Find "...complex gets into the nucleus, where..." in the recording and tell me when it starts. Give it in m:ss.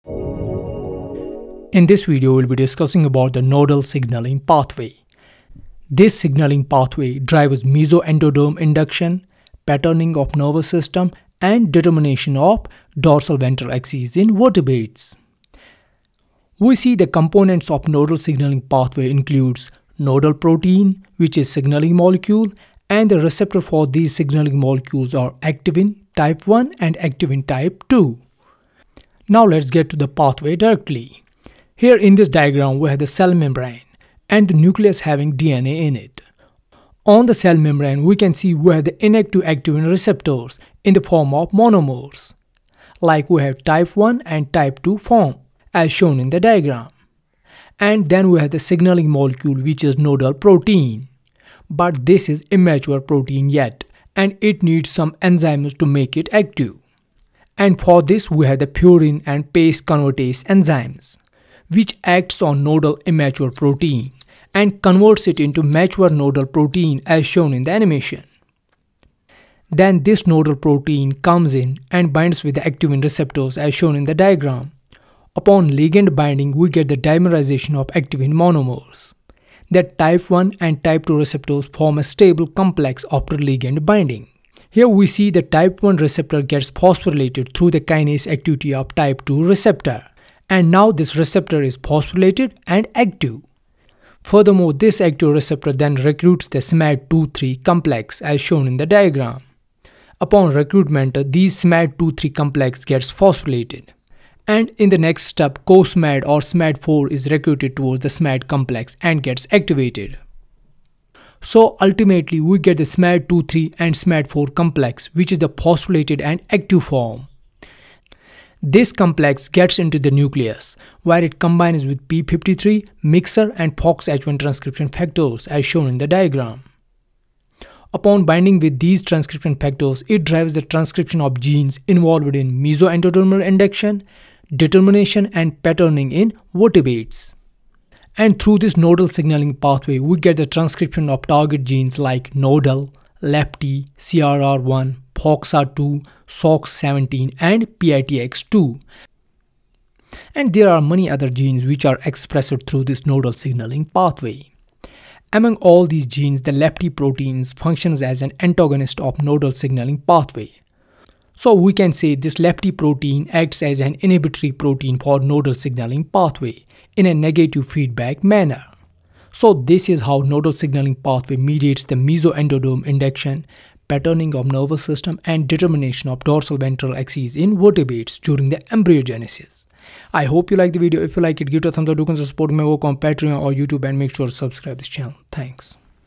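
1:58.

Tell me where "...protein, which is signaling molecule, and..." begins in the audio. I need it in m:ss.
0:20.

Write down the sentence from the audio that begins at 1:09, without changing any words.
Then this nodal protein comes in and binds with the activin receptors as shown in the diagram.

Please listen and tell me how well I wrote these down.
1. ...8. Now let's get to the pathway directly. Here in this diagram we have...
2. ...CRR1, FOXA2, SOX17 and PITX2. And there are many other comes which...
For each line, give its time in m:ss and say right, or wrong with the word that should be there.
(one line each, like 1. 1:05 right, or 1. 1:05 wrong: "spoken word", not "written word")
1. 0:27 wrong: "2", not "8"
2. 2:23 wrong: "genes", not "comes".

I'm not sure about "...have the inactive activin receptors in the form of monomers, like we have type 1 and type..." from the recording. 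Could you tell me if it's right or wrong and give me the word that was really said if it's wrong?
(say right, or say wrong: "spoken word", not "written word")
right.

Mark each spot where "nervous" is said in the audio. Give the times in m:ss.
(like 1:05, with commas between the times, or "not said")
0:10, 2:54.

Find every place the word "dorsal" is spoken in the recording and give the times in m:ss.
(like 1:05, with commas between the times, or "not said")
0:12, 2:56.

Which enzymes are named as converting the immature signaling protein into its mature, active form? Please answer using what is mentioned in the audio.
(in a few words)
Furin and PACE convertase.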